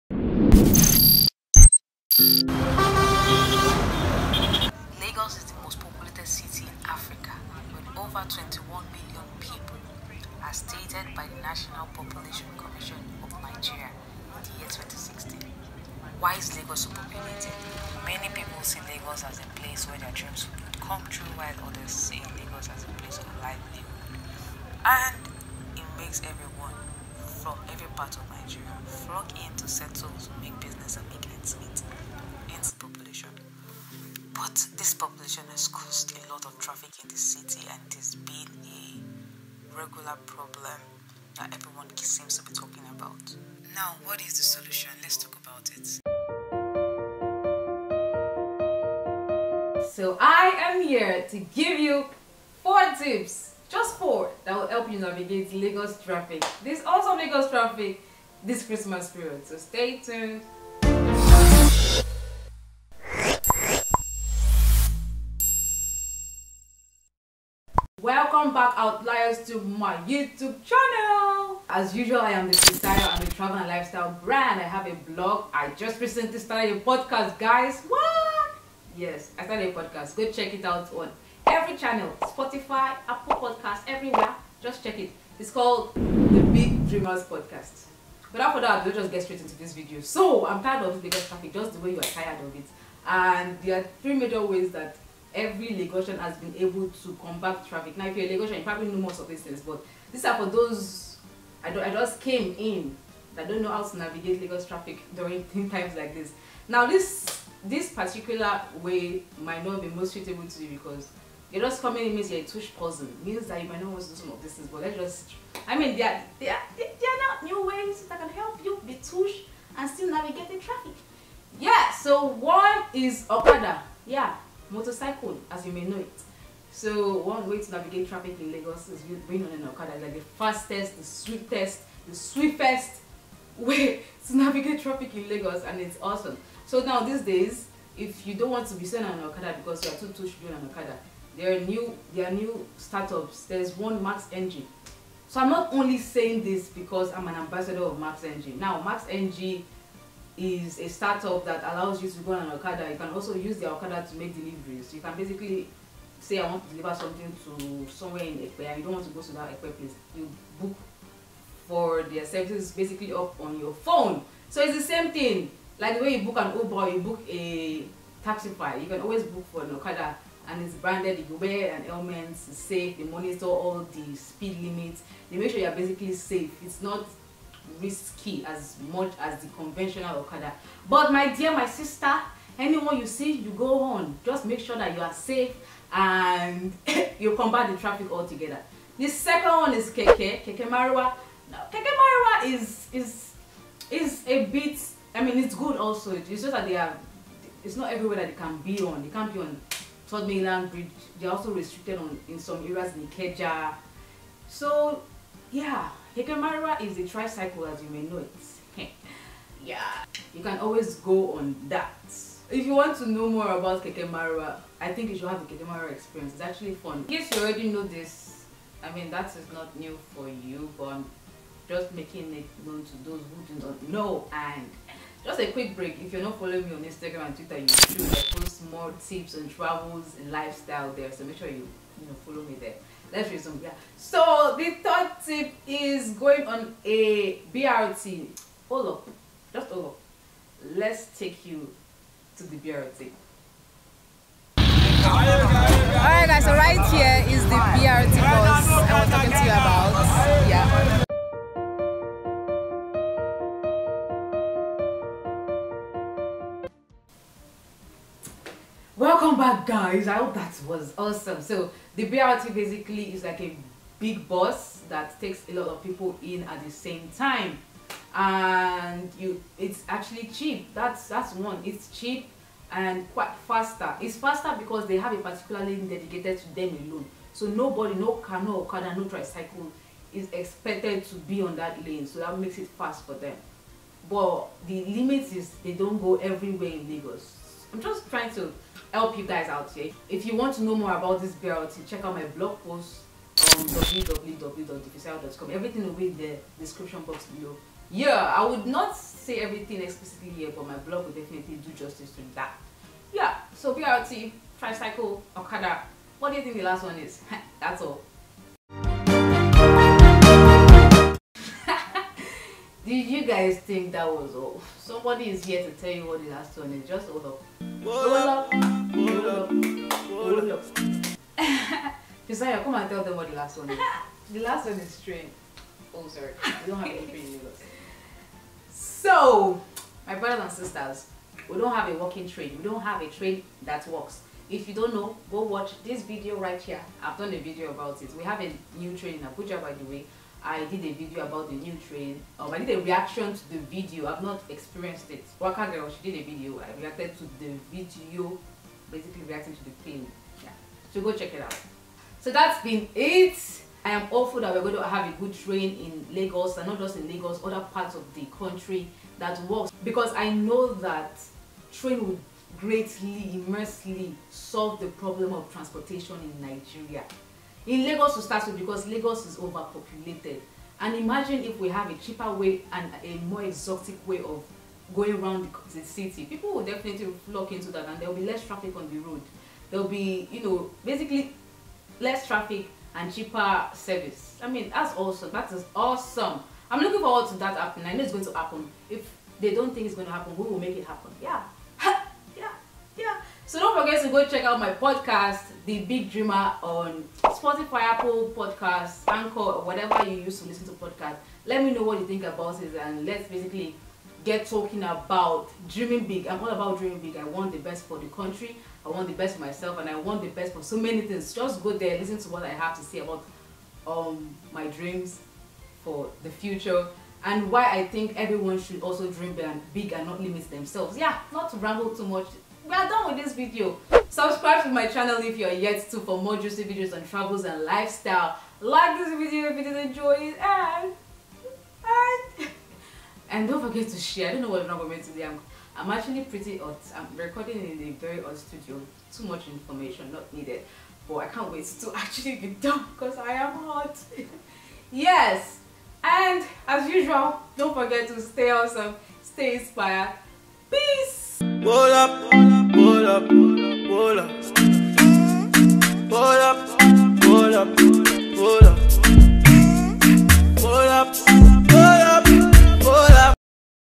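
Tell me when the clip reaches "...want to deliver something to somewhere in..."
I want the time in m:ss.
2:36.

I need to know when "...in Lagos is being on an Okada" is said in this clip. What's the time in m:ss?
2:08.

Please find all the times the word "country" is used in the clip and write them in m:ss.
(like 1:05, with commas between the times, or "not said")
5:58, 6:48.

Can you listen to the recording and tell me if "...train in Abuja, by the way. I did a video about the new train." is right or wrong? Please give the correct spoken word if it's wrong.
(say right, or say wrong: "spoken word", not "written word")
right.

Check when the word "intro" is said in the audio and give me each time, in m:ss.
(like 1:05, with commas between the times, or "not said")
not said.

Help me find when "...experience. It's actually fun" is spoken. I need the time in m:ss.
3:35.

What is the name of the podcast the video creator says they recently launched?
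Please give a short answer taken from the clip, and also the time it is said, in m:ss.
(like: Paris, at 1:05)
The Big Dreamers Podcast, at 1:25.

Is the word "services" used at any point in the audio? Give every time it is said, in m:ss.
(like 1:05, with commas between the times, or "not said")
2:42, 6:23.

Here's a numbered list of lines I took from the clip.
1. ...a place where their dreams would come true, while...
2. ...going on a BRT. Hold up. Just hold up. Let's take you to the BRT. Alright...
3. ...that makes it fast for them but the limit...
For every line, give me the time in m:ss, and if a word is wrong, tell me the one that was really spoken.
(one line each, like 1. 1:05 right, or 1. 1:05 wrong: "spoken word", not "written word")
1. 0:19 right
2. 3:56 right
3. 4:42 right.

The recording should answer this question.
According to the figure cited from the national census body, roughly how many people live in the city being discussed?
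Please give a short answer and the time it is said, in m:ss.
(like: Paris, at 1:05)
over 21 million, at 0:08.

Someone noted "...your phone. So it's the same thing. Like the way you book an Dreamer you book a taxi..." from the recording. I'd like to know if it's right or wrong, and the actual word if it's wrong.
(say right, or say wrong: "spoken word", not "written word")
wrong: "Uber", not "Dreamer".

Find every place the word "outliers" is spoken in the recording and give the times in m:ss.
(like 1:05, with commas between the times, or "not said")
1:08.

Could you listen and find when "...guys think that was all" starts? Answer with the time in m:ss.
5:13.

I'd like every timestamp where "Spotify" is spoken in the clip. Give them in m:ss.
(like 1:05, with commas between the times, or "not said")
1:22, 6:37.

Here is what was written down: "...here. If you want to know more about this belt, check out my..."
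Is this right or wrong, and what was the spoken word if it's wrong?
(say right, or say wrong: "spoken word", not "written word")
right.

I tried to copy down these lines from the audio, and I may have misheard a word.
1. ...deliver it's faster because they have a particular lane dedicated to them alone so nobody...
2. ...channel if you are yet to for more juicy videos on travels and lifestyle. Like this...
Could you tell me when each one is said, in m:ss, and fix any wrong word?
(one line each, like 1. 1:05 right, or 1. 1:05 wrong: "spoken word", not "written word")
1. 4:33 wrong: "faster", not "deliver"
2. 7:04 right.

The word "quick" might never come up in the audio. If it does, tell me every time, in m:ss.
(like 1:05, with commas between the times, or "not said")
3:45.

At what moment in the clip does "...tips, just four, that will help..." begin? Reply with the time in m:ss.
0:52.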